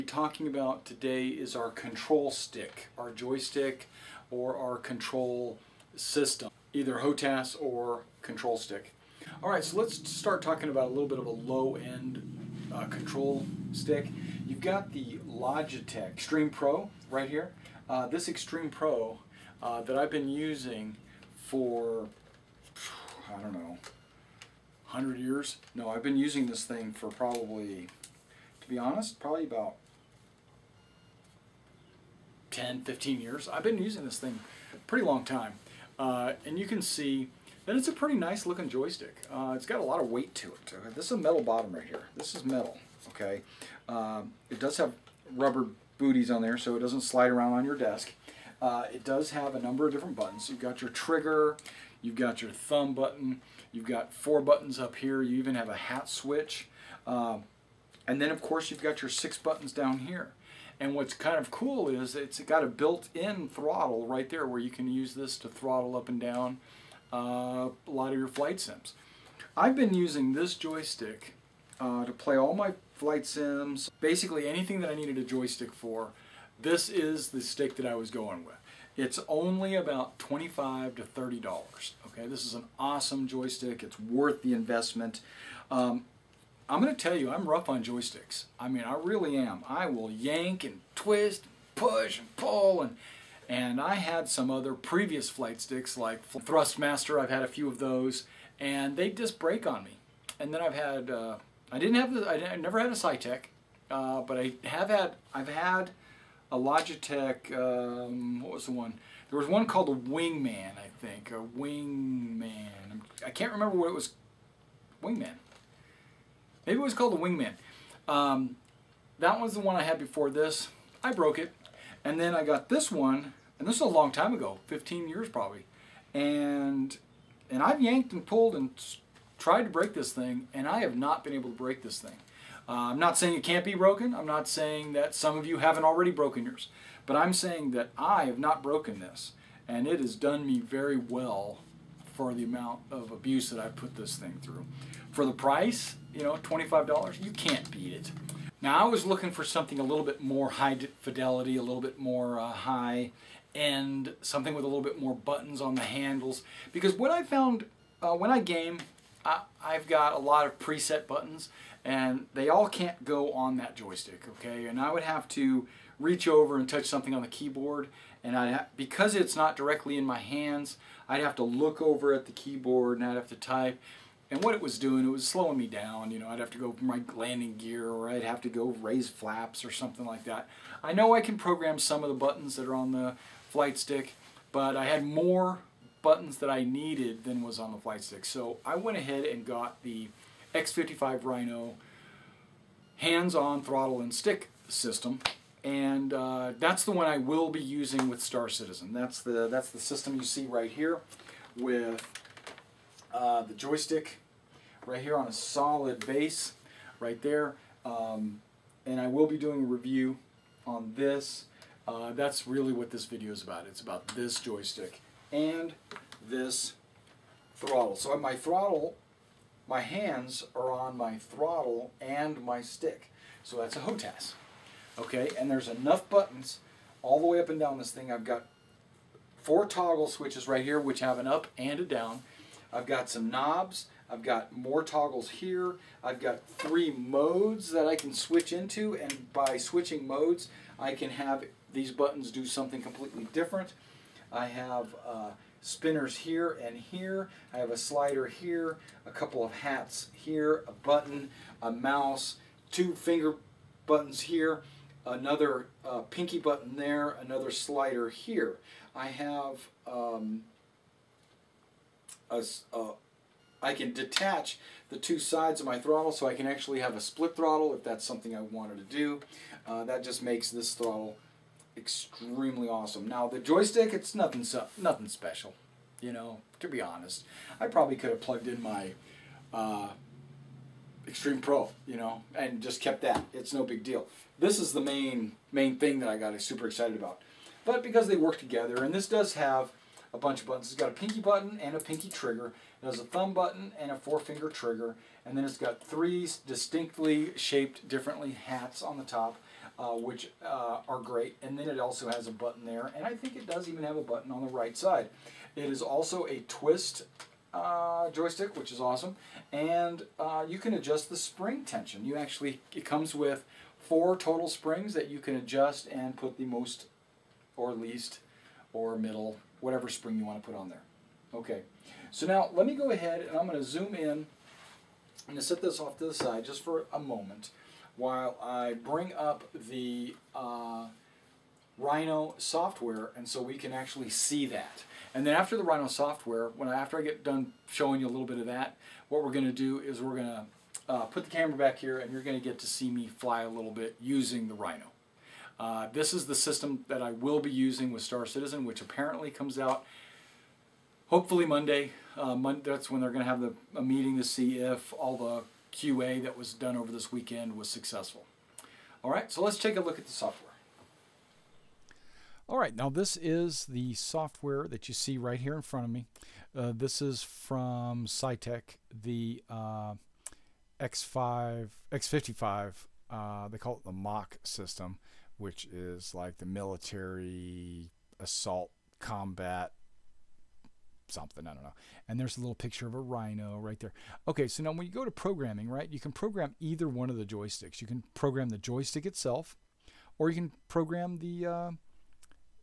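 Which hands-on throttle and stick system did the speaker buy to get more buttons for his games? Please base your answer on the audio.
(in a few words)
X55 Rhino.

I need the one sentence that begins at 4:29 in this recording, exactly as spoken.
Uh, that just makes this throttle extremely awesome.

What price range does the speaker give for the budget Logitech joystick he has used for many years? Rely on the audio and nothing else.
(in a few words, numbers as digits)
$25 to $30.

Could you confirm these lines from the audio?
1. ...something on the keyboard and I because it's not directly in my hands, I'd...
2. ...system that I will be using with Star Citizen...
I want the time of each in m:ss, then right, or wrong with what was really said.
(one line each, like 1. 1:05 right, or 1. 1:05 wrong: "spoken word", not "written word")
1. 2:46 right
2. 5:46 right.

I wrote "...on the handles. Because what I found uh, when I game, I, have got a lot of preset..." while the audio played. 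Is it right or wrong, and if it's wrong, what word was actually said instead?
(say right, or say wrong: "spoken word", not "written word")
right.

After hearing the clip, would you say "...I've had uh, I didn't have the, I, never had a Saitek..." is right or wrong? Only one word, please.
right.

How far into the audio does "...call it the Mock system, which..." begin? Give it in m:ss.
6:13.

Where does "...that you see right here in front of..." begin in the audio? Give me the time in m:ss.
6:04.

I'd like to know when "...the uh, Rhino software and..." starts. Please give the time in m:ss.
5:29.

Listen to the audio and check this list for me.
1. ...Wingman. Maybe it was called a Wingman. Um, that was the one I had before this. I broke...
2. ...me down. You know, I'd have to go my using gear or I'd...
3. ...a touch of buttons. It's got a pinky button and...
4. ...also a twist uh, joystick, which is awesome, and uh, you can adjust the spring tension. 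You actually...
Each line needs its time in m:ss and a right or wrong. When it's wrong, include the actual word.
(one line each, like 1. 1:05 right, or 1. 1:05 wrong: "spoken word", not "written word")
1. 1:55 right
2. 2:55 wrong: "landing", not "using"
3. 4:50 wrong: "bunch", not "touch"
4. 5:05 right.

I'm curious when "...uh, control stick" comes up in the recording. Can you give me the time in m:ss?
0:12.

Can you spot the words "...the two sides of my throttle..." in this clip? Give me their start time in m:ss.
4:24.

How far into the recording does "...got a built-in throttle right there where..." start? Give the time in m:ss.
1:02.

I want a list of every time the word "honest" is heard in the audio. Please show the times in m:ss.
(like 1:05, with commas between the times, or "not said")
0:28, 4:36.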